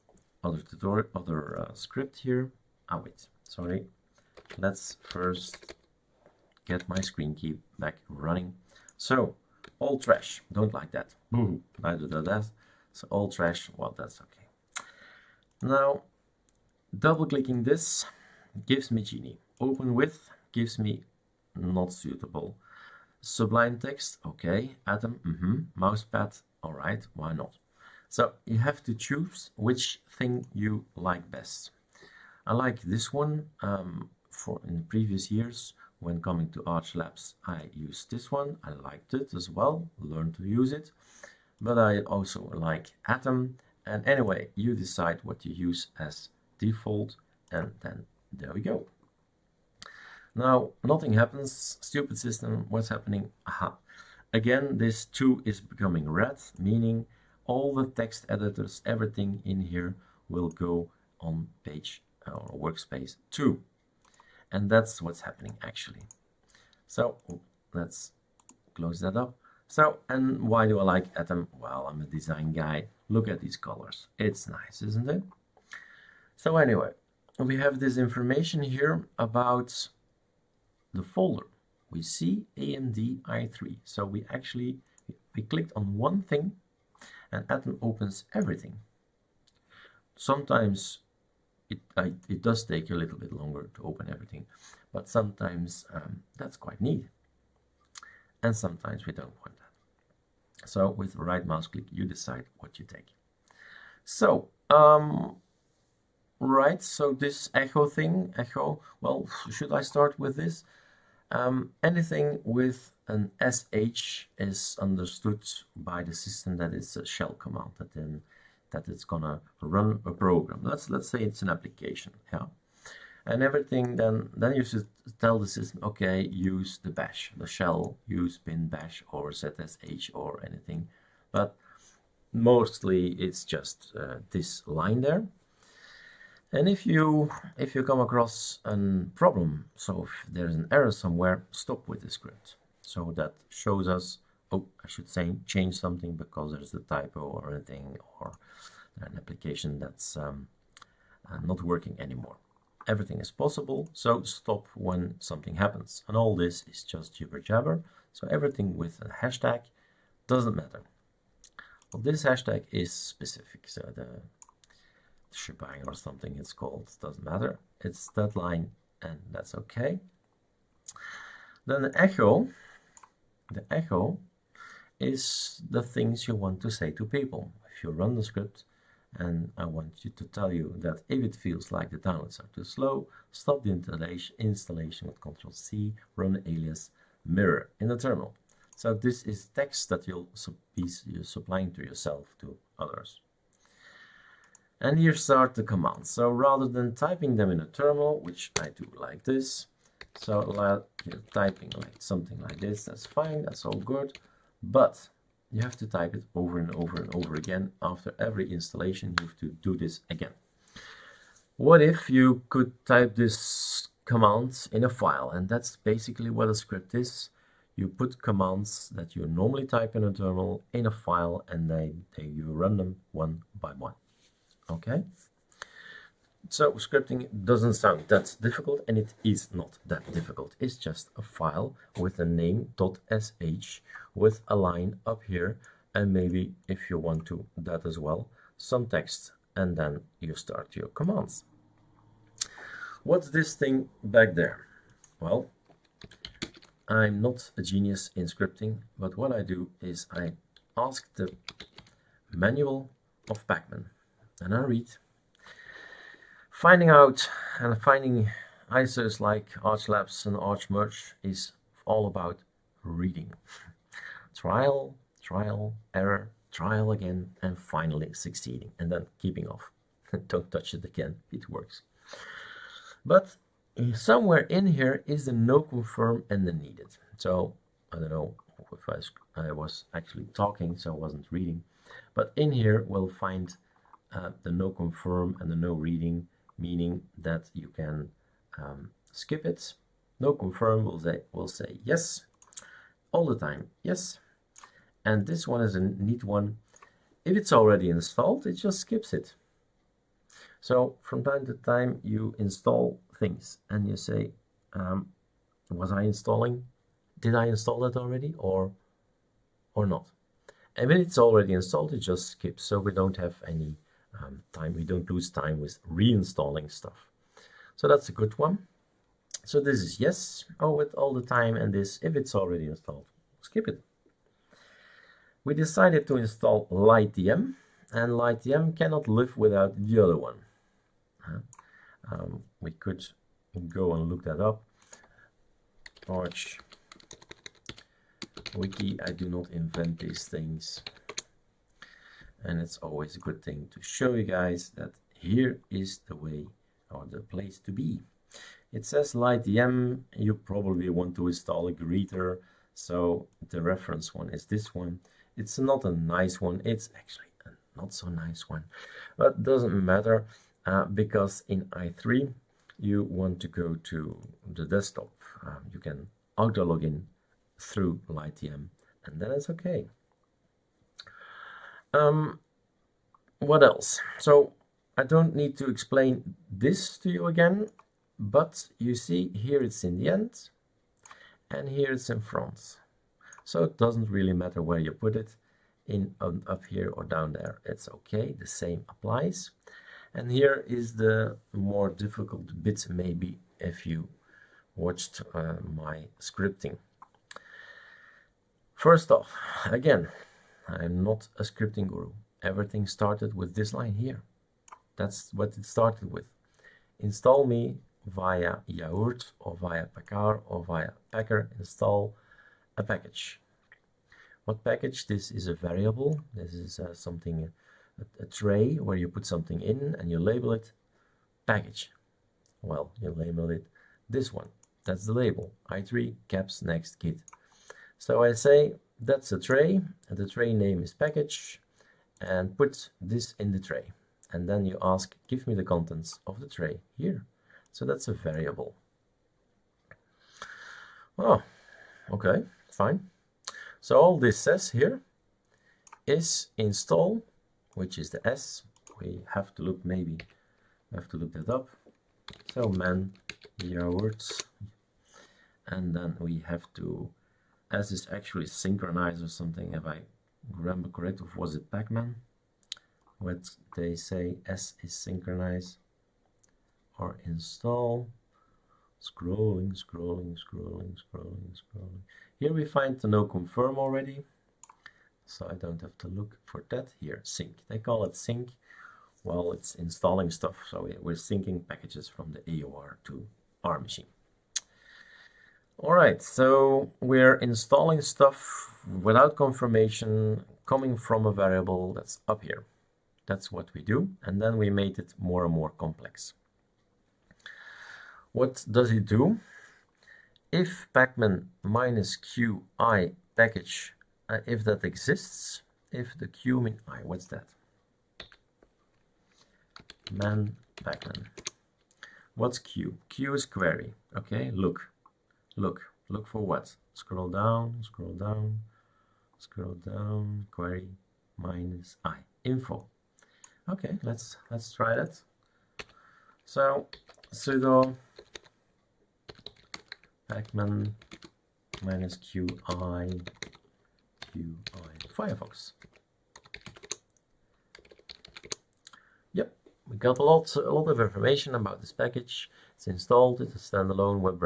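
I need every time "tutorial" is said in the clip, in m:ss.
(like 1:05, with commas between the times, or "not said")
0:00.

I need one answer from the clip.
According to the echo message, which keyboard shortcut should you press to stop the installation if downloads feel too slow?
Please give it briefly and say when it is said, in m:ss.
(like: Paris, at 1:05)
Control C, at 3:05.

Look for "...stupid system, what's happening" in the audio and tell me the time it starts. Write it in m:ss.
0:51.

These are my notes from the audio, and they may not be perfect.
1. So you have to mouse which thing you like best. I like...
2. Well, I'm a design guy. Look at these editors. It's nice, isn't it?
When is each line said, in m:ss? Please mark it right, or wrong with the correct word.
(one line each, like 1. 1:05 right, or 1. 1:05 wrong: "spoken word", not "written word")
1. 0:28 wrong: "choose", not "mouse"
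2. 1:11 wrong: "colors", not "editors".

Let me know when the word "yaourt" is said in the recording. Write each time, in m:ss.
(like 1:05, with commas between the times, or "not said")
6:48, 7:33.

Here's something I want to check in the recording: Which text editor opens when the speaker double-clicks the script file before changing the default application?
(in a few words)
Geany.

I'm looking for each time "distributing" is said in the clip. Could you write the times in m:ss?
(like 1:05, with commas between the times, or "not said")
not said.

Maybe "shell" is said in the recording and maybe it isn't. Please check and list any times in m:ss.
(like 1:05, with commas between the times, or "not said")
1:57, 2:07.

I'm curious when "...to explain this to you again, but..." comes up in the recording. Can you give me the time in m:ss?
6:15.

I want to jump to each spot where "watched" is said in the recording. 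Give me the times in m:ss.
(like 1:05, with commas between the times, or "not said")
6:34.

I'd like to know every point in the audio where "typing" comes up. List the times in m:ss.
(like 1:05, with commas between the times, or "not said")
3:16, 3:21.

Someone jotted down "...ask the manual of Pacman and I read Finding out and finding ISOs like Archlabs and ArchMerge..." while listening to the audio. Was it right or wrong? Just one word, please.
right.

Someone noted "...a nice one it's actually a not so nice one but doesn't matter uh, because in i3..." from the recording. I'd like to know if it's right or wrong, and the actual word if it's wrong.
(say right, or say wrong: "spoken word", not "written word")
right.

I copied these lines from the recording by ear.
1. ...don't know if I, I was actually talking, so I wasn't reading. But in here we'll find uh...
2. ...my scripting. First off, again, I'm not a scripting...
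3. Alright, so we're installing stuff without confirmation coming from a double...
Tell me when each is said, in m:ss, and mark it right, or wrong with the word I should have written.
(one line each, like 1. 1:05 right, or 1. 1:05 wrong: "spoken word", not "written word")
1. 4:37 right
2. 6:35 right
3. 8:05 wrong: "variable", not "double".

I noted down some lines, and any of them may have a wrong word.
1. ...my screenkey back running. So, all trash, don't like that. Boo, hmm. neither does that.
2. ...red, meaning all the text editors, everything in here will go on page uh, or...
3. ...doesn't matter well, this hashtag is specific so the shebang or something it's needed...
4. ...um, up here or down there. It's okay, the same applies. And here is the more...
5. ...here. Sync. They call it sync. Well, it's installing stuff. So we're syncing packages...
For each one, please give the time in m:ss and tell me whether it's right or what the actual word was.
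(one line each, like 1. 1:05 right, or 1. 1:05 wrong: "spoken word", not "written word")
1. 0:06 right
2. 0:56 right
3. 2:40 wrong: "called", not "needed"
4. 6:26 right
5. 7:56 right.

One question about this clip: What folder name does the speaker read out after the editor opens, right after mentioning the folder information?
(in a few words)
AMD i3.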